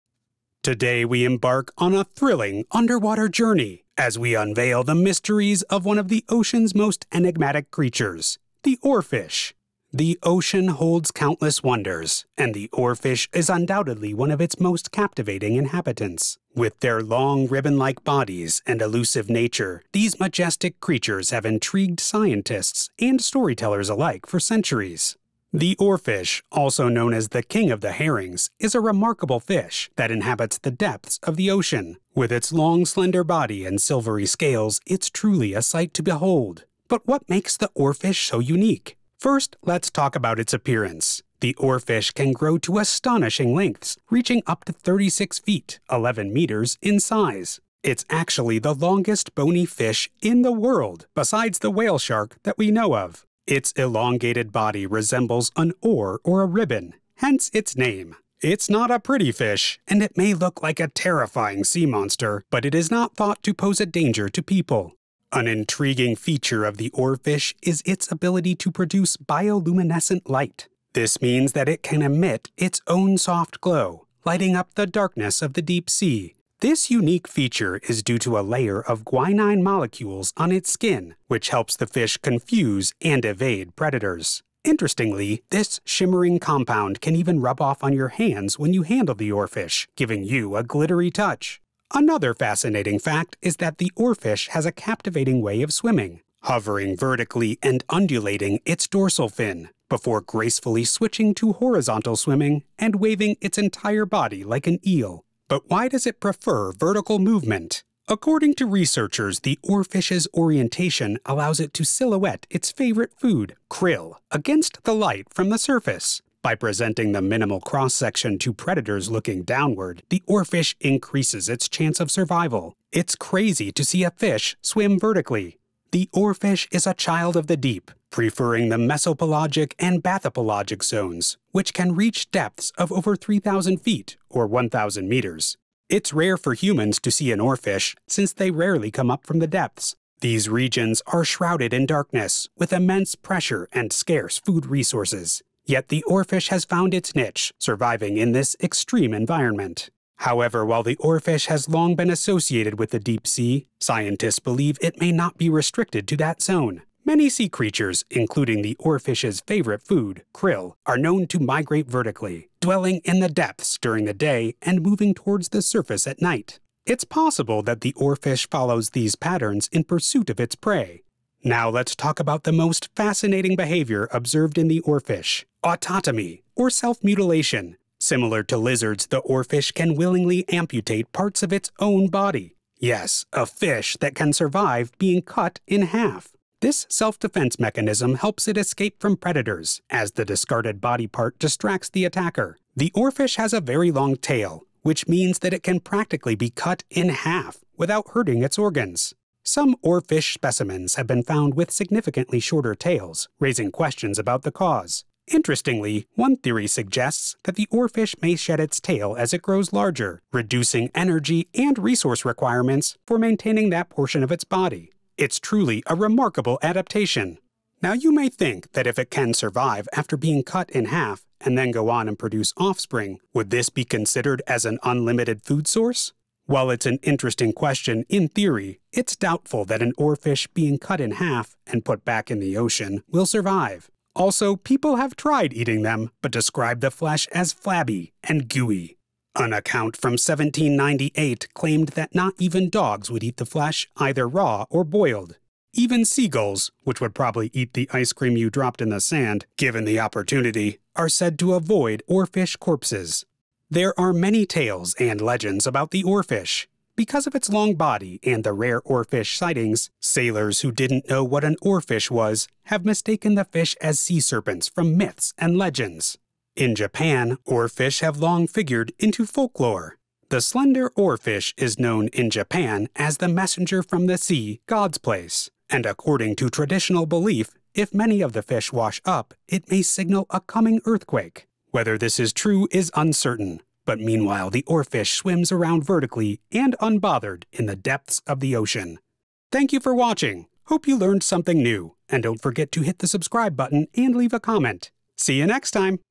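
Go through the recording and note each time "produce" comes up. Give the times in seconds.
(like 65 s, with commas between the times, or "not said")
68 s, 222 s.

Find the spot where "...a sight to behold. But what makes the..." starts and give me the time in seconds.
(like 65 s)
35 s.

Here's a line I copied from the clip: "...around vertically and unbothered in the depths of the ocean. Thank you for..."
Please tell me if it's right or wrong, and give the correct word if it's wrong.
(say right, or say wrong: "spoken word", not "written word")
right.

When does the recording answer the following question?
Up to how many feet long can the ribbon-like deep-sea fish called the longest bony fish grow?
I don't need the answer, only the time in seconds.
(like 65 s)
44 s.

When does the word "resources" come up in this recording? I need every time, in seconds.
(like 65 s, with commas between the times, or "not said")
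144 s, 211 s.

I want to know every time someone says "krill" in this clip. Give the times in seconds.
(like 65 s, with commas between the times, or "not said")
113 s, 160 s.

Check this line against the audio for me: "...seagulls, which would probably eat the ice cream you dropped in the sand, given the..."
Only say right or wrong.
right.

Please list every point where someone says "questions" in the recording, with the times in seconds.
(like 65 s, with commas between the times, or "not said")
203 s, 227 s.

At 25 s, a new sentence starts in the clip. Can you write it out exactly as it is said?
The oarfish, also known as the king of the herrings, is a remarkable fish that inhabits the depths of the ocean.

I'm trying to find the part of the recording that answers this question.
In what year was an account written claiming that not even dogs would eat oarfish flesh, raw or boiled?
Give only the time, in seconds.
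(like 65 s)
240 s.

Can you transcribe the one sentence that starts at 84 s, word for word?
Interestingly, this shimmering compound can even rub off on your hands when you handle the oarfish, giving you a glittery touch.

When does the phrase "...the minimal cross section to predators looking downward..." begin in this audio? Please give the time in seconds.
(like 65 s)
117 s.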